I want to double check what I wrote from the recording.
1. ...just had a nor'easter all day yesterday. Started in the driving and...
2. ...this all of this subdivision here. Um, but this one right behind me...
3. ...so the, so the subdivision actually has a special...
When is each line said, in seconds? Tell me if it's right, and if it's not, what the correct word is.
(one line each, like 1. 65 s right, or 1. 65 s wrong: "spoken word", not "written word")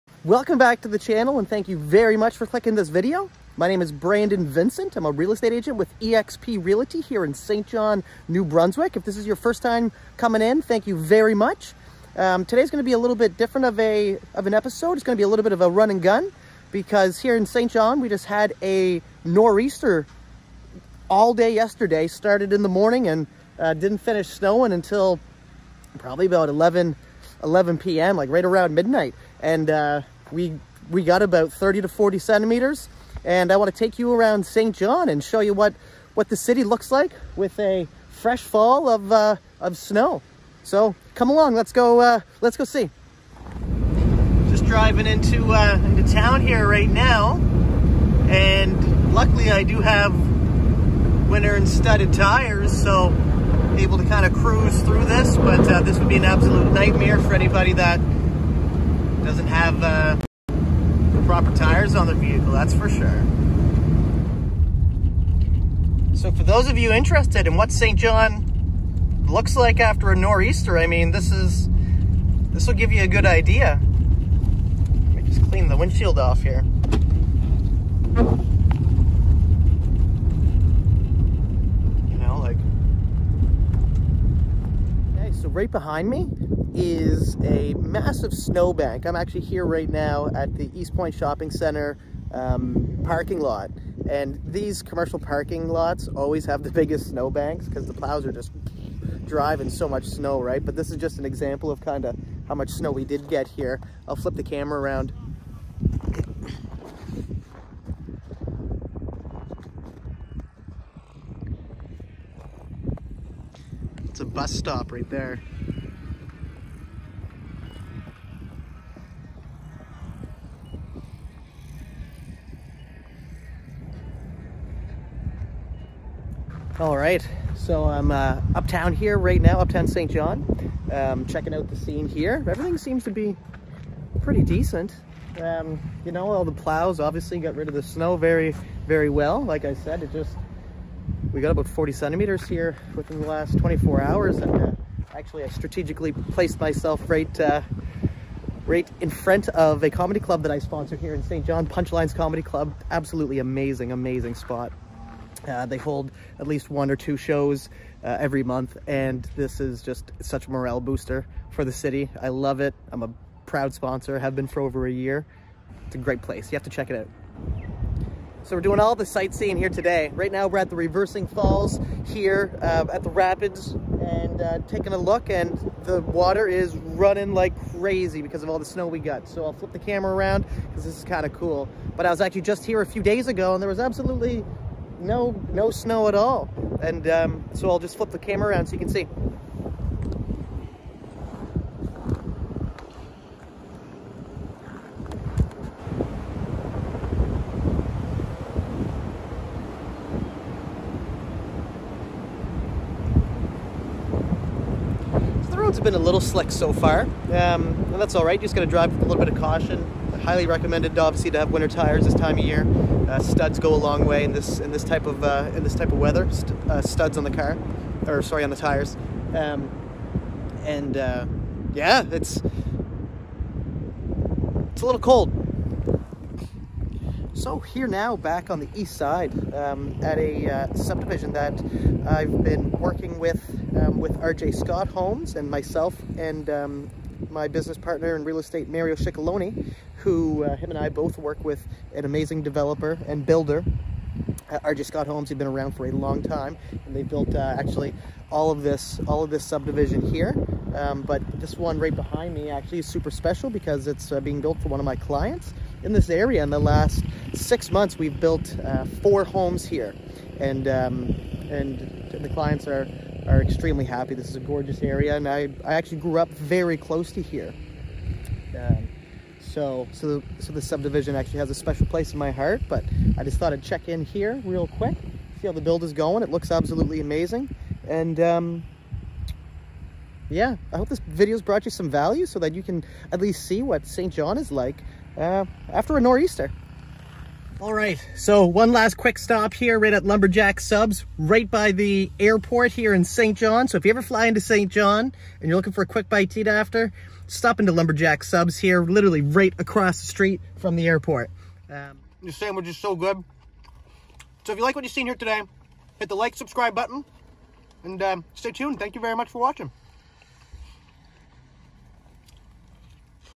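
1. 18 s wrong: "morning", not "driving"
2. 248 s right
3. 269 s right.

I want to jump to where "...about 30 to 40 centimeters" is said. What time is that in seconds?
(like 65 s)
31 s.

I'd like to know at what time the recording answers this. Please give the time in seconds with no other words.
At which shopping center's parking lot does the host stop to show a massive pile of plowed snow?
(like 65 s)
90 s.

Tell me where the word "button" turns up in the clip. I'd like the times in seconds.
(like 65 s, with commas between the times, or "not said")
306 s.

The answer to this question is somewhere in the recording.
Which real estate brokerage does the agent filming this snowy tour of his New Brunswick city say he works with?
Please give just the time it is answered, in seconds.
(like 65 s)
5 s.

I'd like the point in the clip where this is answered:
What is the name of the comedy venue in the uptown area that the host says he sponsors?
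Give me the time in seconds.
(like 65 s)
151 s.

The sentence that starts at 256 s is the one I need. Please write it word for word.
In the last six months, we've built uh, four homes here, and um, and the clients are are extremely happy.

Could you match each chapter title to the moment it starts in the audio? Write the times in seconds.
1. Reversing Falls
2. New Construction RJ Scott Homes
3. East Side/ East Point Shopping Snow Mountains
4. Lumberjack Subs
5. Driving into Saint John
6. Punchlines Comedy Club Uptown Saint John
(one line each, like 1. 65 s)
1. 169 s
2. 225 s
3. 64 s
4. 285 s
5. 43 s
6. 130 s.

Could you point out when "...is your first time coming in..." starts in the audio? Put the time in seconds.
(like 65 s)
9 s.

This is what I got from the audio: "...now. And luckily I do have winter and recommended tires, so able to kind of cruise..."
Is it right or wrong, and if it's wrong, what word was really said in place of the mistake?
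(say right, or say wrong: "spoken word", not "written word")
wrong: "studded", not "recommended".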